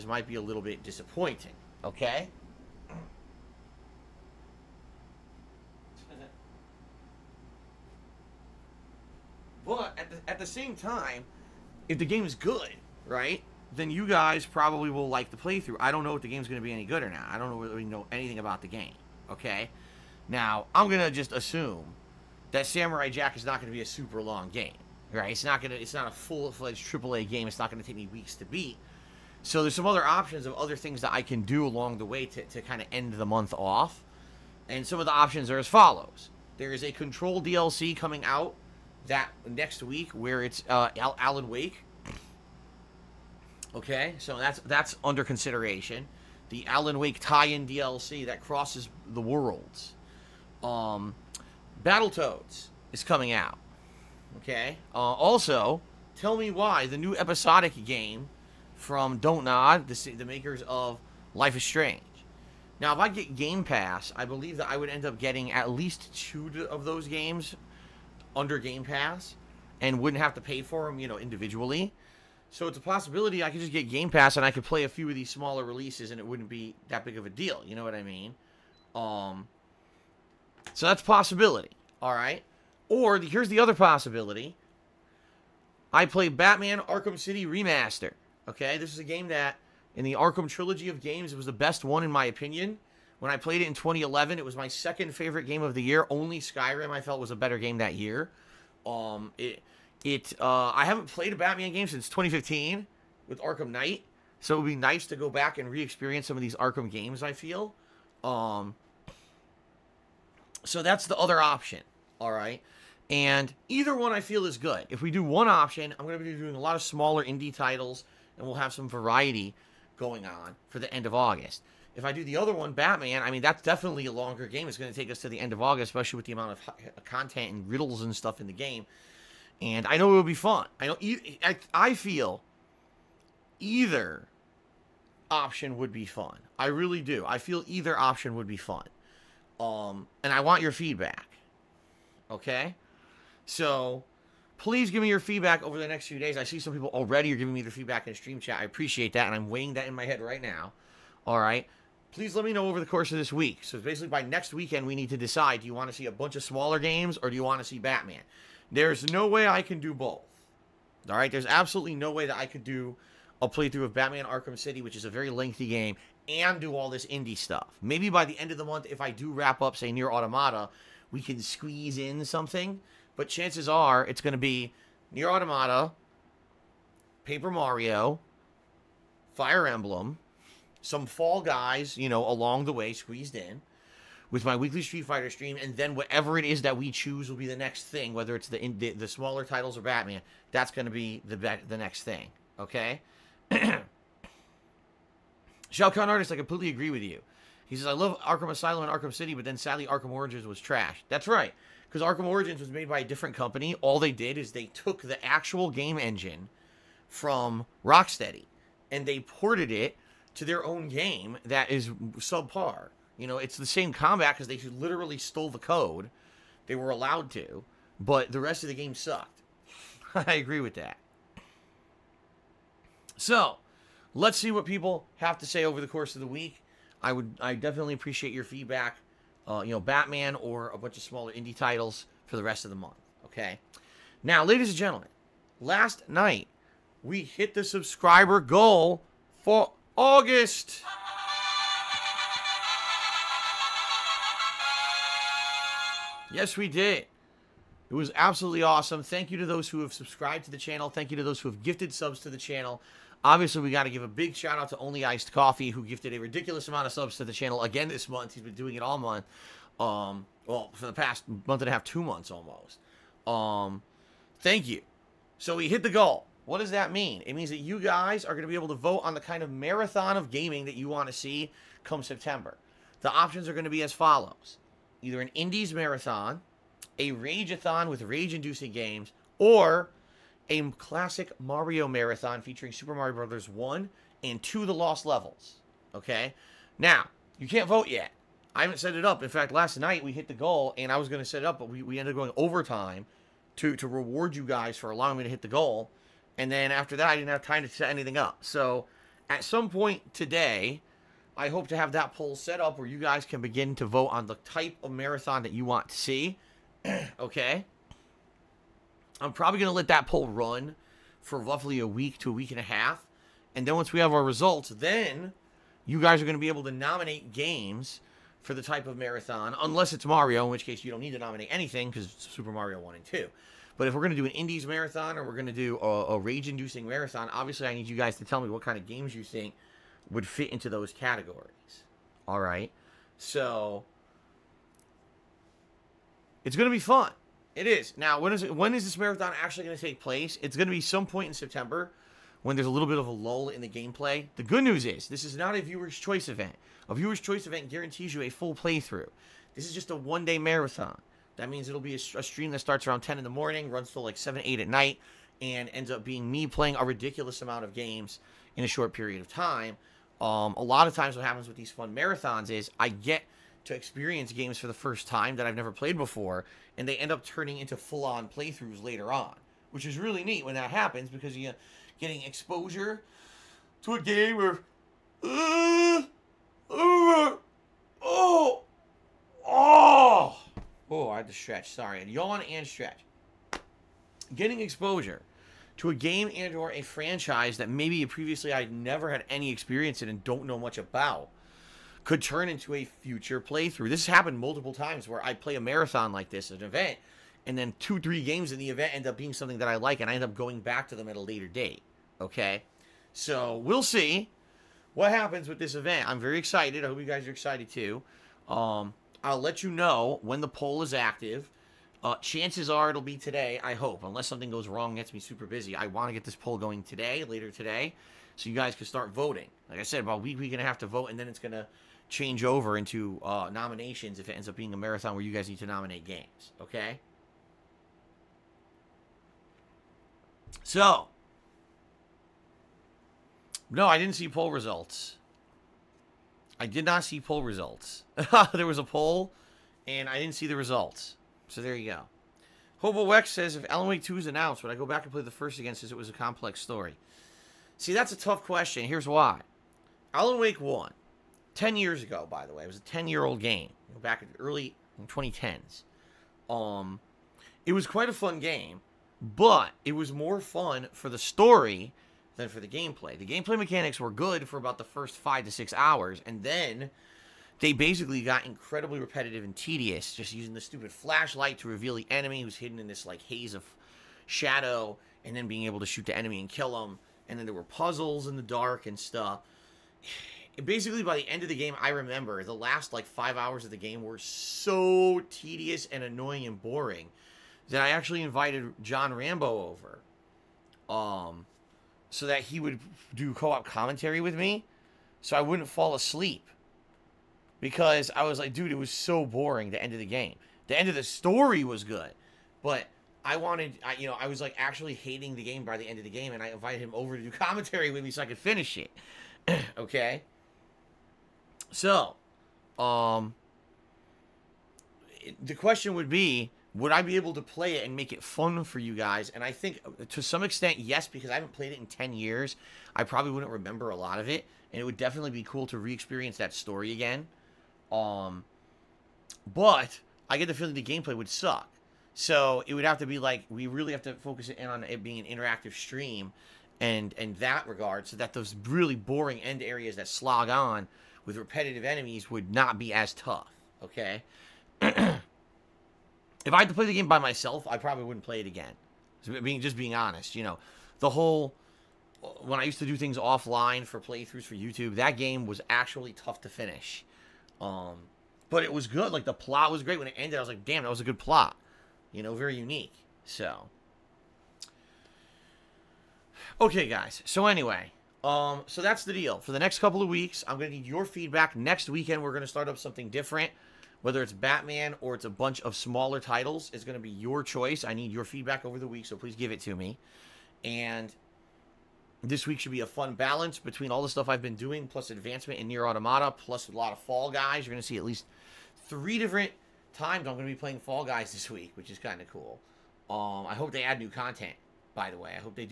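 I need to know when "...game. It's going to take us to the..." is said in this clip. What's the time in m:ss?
2:04.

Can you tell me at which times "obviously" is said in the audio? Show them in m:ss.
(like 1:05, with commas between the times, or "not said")
4:13, 5:27.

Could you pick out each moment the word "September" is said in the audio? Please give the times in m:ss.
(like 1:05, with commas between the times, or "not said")
4:32, 5:41.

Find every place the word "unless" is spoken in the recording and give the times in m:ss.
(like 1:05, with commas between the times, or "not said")
5:19, 6:54.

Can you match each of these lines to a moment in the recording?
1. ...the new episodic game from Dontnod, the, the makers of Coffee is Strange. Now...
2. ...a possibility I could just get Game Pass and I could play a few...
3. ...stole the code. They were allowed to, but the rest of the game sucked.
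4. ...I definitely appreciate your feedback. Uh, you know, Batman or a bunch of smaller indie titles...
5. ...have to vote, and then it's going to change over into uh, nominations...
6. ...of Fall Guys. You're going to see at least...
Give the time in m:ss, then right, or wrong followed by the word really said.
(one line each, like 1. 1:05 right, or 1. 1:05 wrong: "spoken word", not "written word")
1. 0:56 wrong: "Life", not "Coffee"
2. 1:12 right
3. 3:35 right
4. 3:47 right
5. 7:00 right
6. 9:46 right.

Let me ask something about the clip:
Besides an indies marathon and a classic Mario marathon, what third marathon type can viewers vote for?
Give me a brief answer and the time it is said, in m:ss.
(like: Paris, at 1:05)
Rageathon, at 4:36.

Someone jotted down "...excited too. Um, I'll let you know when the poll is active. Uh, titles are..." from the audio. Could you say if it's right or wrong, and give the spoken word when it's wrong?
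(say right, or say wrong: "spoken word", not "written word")
wrong: "chances", not "titles".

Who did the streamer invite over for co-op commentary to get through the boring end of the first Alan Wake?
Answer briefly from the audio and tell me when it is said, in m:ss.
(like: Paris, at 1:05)
John Rambo, at 8:08.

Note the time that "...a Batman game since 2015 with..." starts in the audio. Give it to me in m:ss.
1:41.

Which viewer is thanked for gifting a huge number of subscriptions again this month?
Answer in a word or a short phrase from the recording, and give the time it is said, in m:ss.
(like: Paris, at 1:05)
Only Iced Coffee, at 4:14.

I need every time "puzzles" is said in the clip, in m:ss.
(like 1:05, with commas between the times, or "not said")
7:57.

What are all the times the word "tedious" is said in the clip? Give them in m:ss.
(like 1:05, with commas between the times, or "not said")
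7:49, 8:05.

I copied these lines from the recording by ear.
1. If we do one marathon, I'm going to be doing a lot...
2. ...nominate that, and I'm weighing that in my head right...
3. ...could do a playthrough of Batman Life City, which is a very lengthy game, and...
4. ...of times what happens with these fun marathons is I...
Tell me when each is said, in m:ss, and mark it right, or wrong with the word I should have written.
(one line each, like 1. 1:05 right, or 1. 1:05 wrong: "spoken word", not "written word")
1. 1:54 wrong: "option", not "marathon"
2. 2:28 wrong: "appreciate", not "nominate"
3. 2:42 wrong: "Arkham", not "Life"
4. 6:00 right.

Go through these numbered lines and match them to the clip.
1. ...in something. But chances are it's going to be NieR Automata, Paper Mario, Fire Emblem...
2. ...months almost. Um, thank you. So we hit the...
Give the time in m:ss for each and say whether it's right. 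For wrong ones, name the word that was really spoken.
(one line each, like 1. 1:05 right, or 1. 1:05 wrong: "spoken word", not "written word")
1. 2:51 right
2. 4:22 right.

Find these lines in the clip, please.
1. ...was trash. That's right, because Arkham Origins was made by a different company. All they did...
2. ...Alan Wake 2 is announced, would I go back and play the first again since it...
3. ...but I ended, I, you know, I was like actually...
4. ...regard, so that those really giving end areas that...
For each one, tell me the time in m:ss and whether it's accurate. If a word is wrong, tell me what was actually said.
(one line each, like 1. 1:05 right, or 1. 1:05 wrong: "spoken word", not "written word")
1. 3:20 right
2. 7:23 right
3. 8:22 wrong: "wanted", not "ended"
4. 8:57 wrong: "boring", not "giving".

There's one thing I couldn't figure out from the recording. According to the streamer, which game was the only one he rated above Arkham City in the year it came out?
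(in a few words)
Skyrim.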